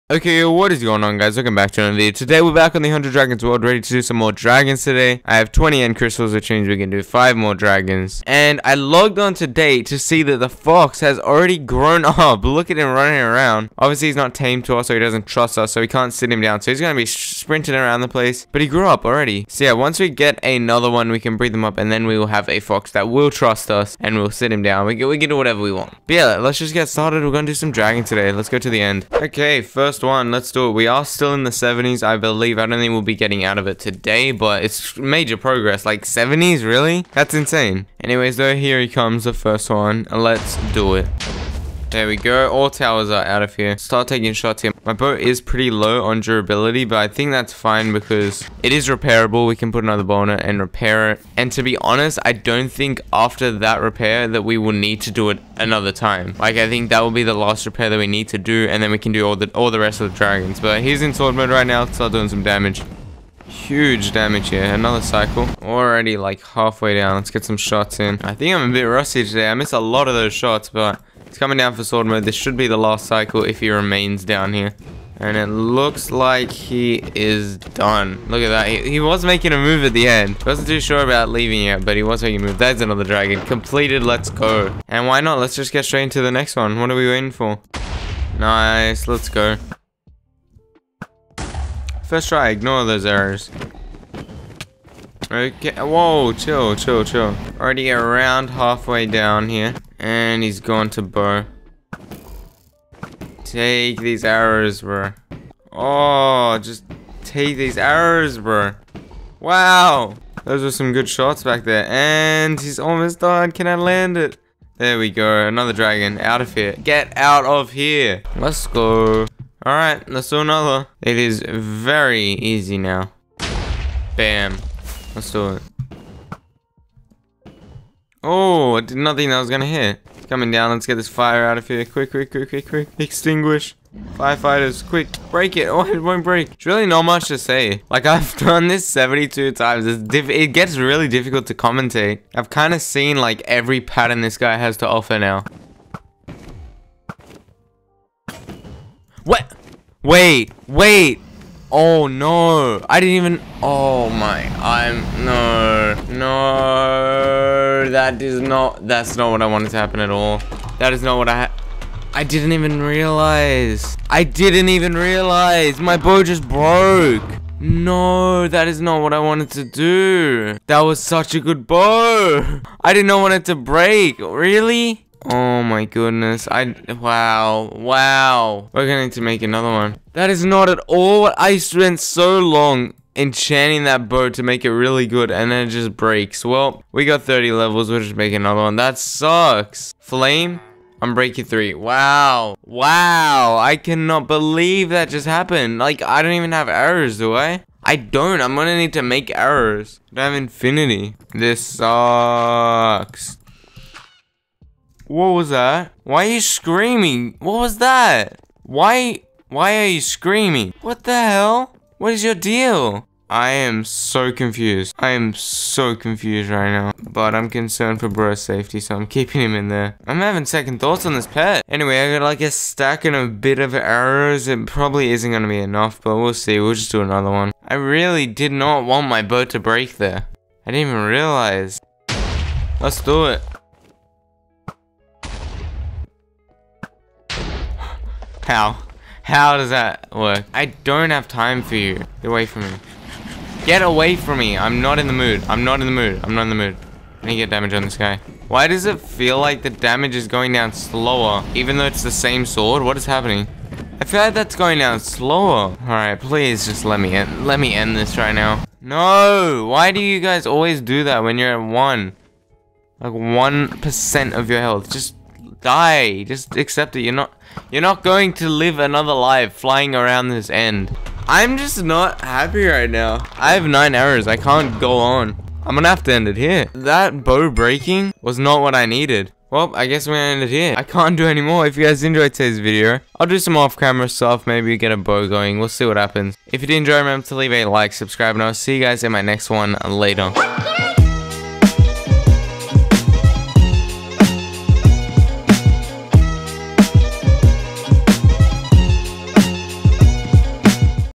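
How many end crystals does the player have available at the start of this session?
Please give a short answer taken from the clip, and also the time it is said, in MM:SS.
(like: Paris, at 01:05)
20, at 00:05.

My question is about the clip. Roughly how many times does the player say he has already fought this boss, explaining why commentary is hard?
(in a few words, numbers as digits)
72.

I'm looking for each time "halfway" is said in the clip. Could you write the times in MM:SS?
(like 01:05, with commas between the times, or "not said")
01:06, 01:38.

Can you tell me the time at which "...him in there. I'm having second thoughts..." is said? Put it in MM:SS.
03:39.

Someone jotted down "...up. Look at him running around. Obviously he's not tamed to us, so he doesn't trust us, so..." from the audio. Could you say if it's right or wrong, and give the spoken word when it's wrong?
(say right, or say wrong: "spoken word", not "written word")
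right.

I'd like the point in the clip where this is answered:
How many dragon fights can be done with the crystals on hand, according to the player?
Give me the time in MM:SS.
00:07.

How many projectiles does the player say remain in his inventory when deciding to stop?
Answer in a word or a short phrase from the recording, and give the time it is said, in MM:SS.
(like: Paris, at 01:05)
9, at 04:33.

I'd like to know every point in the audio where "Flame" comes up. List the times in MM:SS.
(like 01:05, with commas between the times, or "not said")
03:09.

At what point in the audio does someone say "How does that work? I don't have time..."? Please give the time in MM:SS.
03:59.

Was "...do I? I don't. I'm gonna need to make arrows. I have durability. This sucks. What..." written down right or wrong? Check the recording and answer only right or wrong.
wrong.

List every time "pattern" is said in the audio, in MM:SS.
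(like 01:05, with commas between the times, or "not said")
02:23.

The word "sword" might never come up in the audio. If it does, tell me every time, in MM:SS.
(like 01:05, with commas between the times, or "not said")
01:01, 01:11, 04:12.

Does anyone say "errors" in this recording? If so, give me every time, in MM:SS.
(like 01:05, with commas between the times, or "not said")
01:33, 04:33.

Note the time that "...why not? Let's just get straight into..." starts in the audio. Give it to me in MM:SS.
01:25.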